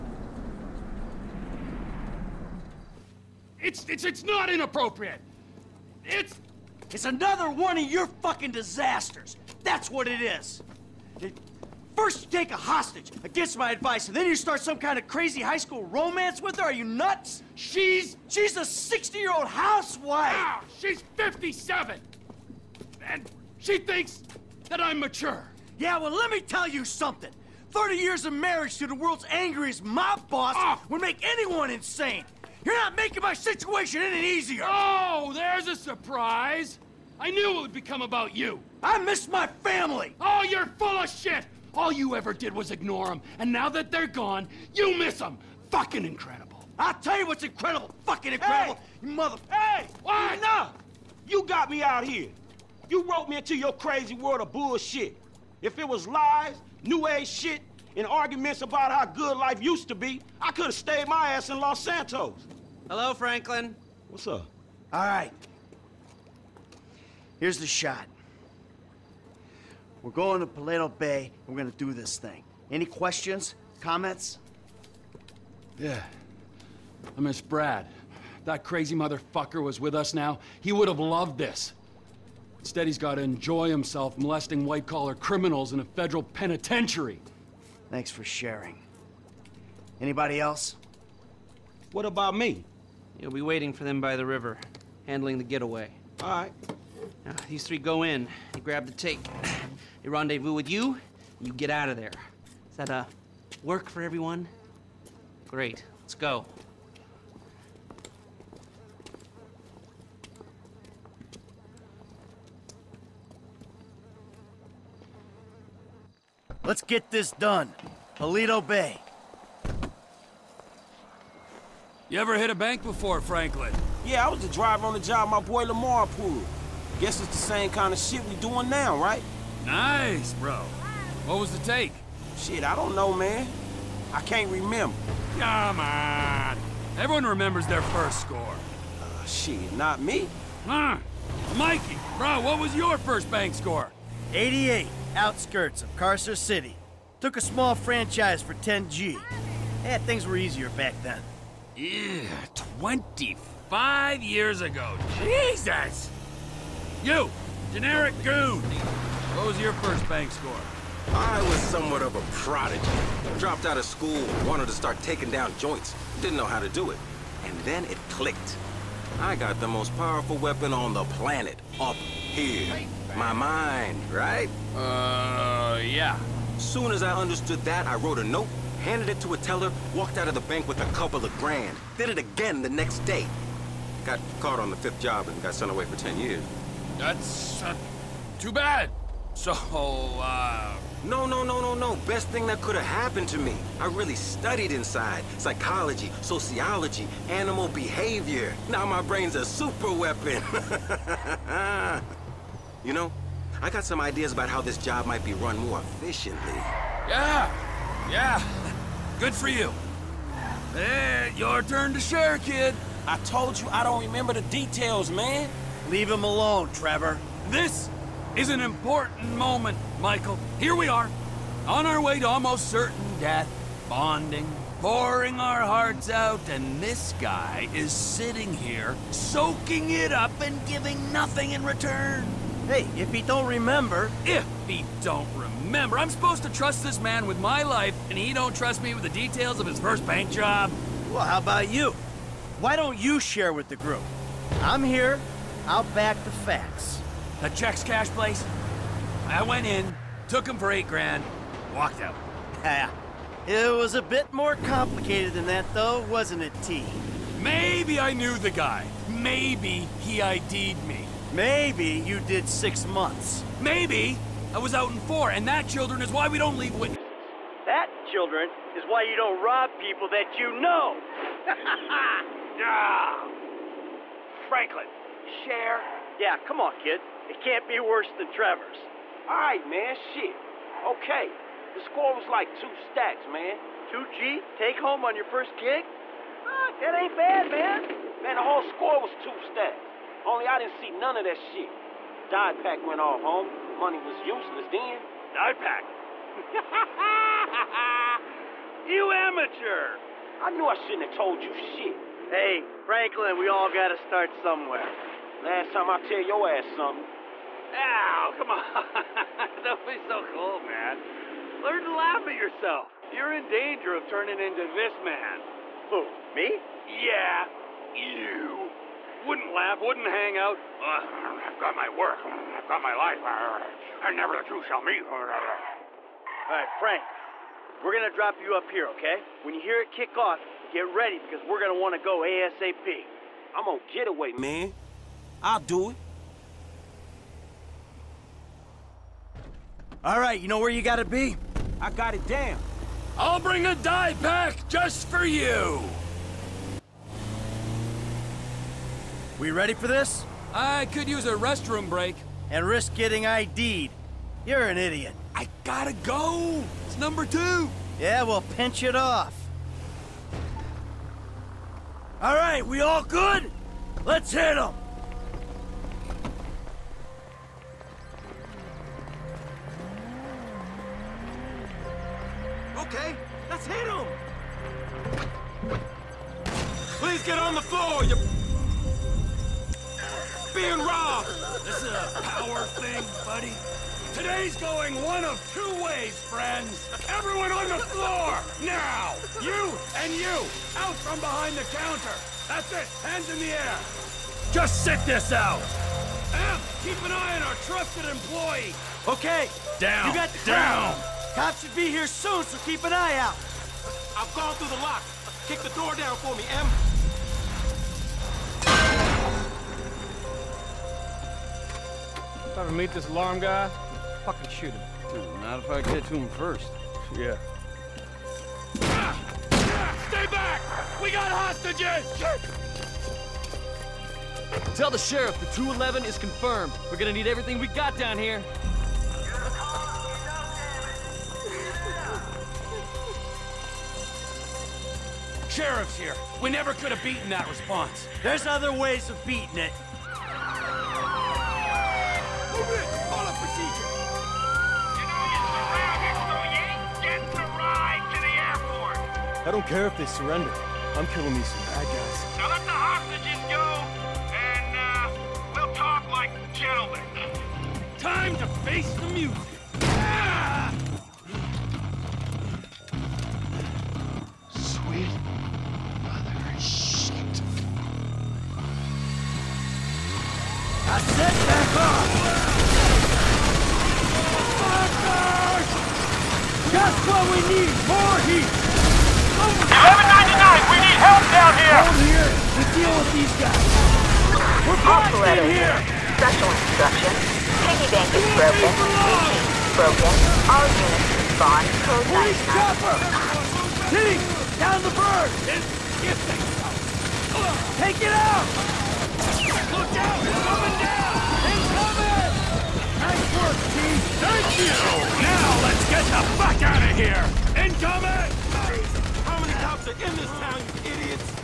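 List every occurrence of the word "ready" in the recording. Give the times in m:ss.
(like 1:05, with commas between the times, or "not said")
5:30, 5:49.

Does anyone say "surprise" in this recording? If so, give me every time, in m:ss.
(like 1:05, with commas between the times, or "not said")
0:35.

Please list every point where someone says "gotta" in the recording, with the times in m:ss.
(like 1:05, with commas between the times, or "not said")
5:03, 5:40, 5:55.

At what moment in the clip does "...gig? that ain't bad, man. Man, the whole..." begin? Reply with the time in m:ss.
4:45.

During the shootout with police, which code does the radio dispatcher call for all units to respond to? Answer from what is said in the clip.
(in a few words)
Code 99.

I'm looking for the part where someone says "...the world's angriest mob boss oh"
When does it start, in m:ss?
0:28.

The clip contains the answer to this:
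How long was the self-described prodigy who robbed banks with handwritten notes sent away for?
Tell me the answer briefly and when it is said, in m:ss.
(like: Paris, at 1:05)
10 years, at 3:05.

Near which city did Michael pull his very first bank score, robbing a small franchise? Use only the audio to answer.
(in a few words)
Carcer City.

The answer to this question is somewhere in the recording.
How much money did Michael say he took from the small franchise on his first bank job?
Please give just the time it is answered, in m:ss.
2:28.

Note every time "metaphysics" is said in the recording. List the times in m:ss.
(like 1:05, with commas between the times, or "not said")
not said.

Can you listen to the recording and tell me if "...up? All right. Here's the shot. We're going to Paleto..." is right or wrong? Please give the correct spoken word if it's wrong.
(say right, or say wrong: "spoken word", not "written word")
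right.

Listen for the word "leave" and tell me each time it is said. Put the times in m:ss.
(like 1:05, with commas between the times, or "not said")
3:35, 4:26.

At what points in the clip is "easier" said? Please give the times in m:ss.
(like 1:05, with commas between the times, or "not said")
0:34, 2:30.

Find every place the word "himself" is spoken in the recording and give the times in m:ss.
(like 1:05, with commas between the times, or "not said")
1:23.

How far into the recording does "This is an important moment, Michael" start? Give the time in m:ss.
3:37.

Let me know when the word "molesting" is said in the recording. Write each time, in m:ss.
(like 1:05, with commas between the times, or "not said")
1:24.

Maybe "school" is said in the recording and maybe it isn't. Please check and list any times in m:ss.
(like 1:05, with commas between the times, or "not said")
0:15, 2:43.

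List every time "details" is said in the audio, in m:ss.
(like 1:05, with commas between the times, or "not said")
3:34, 3:59.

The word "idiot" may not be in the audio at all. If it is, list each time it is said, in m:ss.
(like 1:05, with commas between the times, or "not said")
5:54, 8:30.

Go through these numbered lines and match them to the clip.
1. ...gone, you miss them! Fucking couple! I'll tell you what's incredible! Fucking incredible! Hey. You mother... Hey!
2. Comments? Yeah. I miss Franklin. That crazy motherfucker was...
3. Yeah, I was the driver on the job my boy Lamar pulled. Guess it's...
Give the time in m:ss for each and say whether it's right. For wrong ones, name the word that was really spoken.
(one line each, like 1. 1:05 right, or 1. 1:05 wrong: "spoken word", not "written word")
1. 0:44 wrong: "incredible", not "couple"
2. 1:13 wrong: "Brad", not "Franklin"
3. 2:04 right.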